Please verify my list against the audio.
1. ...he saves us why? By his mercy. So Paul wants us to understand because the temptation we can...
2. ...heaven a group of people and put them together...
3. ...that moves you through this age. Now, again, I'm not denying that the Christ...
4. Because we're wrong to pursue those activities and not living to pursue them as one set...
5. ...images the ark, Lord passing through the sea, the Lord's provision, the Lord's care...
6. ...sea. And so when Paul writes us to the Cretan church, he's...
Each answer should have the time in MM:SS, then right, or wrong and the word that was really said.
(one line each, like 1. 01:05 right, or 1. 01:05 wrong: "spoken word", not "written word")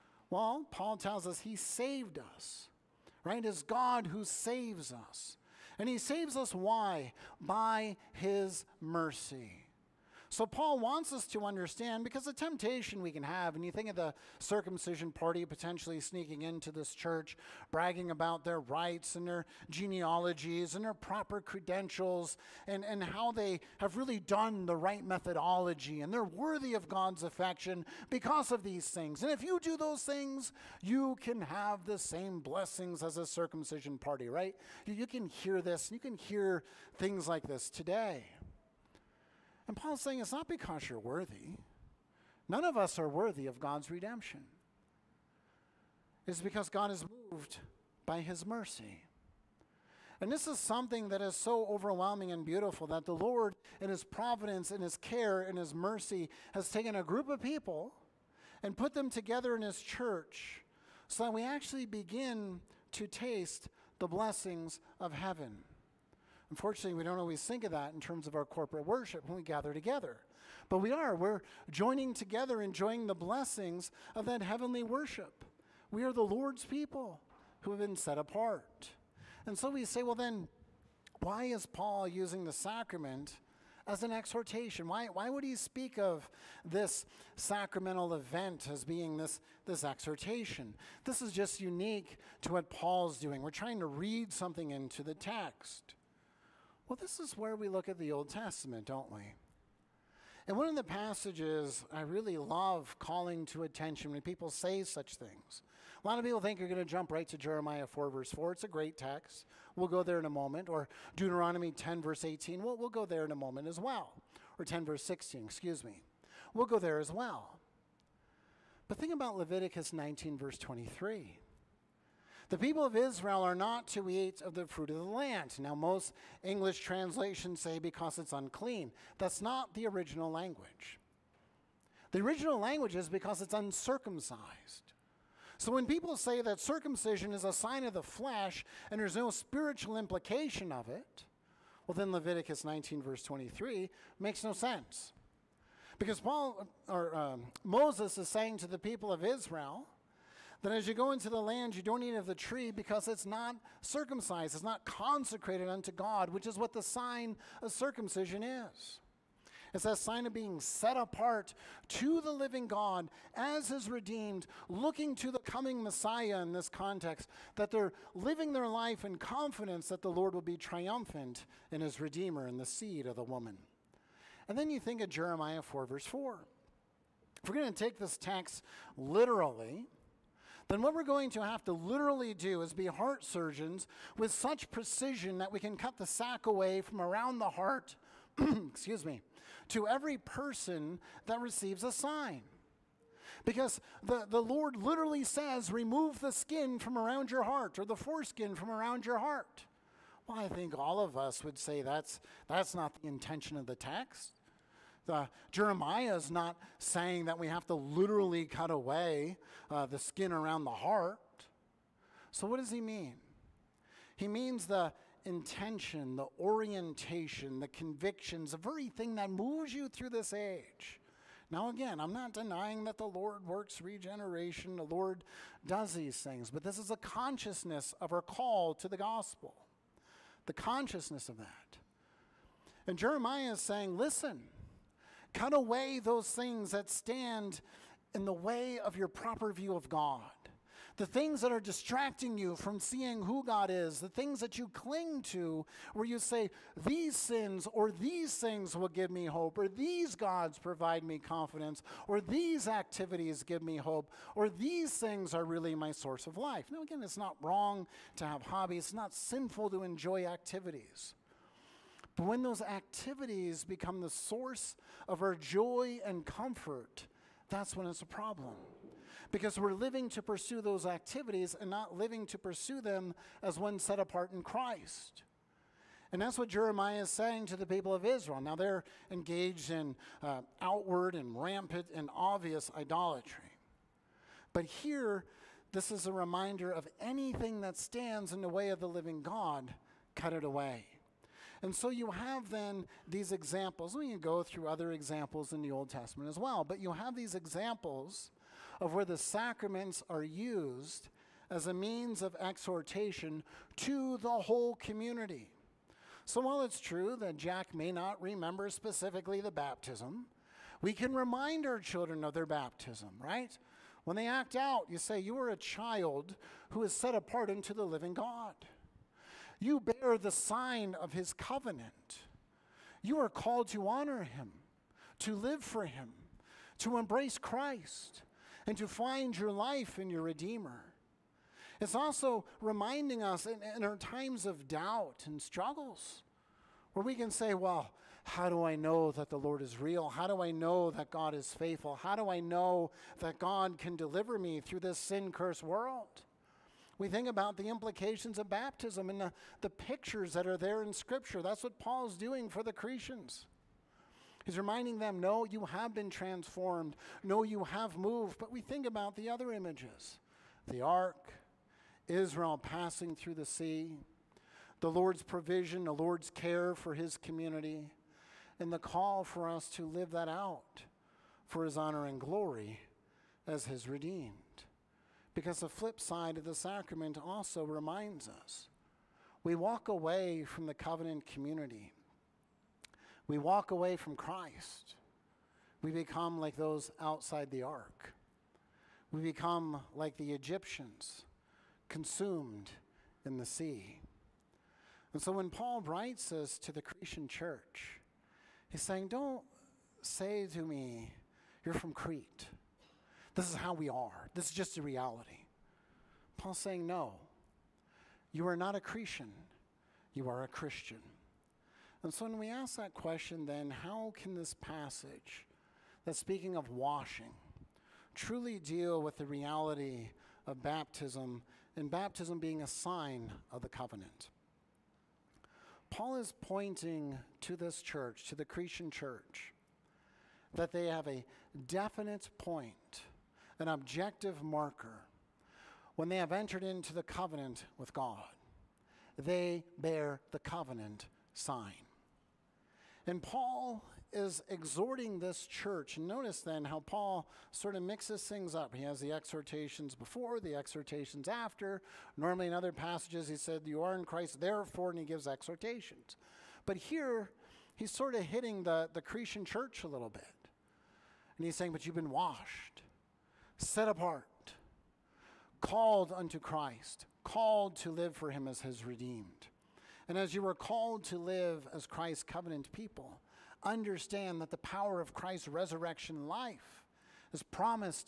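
1. 00:05 right
2. 00:56 wrong: "taken", not "heaven"
3. 03:39 wrong: "Lord", not "Christ"
4. 04:29 wrong: "living", not "wrong"
5. 05:59 wrong: "Israel", not "Lord"
6. 06:33 right.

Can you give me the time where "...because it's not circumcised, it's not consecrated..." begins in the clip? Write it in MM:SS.
02:32.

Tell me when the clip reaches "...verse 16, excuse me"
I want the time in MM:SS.
01:54.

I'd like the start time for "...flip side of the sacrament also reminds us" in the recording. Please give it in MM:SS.
06:15.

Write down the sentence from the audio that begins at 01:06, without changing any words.
Unfortunately, we don't always think of that in terms of our corporate worship when we gather together.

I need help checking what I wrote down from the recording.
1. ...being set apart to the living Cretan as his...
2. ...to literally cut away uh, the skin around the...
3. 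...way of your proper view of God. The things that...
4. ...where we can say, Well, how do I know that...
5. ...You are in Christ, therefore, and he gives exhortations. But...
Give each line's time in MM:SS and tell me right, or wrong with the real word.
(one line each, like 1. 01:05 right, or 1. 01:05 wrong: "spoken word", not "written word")
1. 02:40 wrong: "God", not "Cretan"
2. 03:27 right
3. 03:58 right
4. 05:36 right
5. 07:33 right.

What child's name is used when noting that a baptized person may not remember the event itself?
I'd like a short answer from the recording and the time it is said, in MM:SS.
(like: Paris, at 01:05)
Jack, at 05:07.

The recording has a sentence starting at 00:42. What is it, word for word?
None of us are worthy of God's redemption.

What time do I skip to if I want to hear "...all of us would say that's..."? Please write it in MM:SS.
03:20.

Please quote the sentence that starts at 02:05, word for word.
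Now, most English translations say because it's unclean.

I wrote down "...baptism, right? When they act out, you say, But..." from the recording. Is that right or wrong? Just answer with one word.
wrong.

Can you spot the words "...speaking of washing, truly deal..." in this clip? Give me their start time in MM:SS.
06:56.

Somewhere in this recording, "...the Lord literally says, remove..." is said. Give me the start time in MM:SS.
03:14.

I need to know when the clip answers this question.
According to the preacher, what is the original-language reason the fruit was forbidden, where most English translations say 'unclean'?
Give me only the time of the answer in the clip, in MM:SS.
02:13.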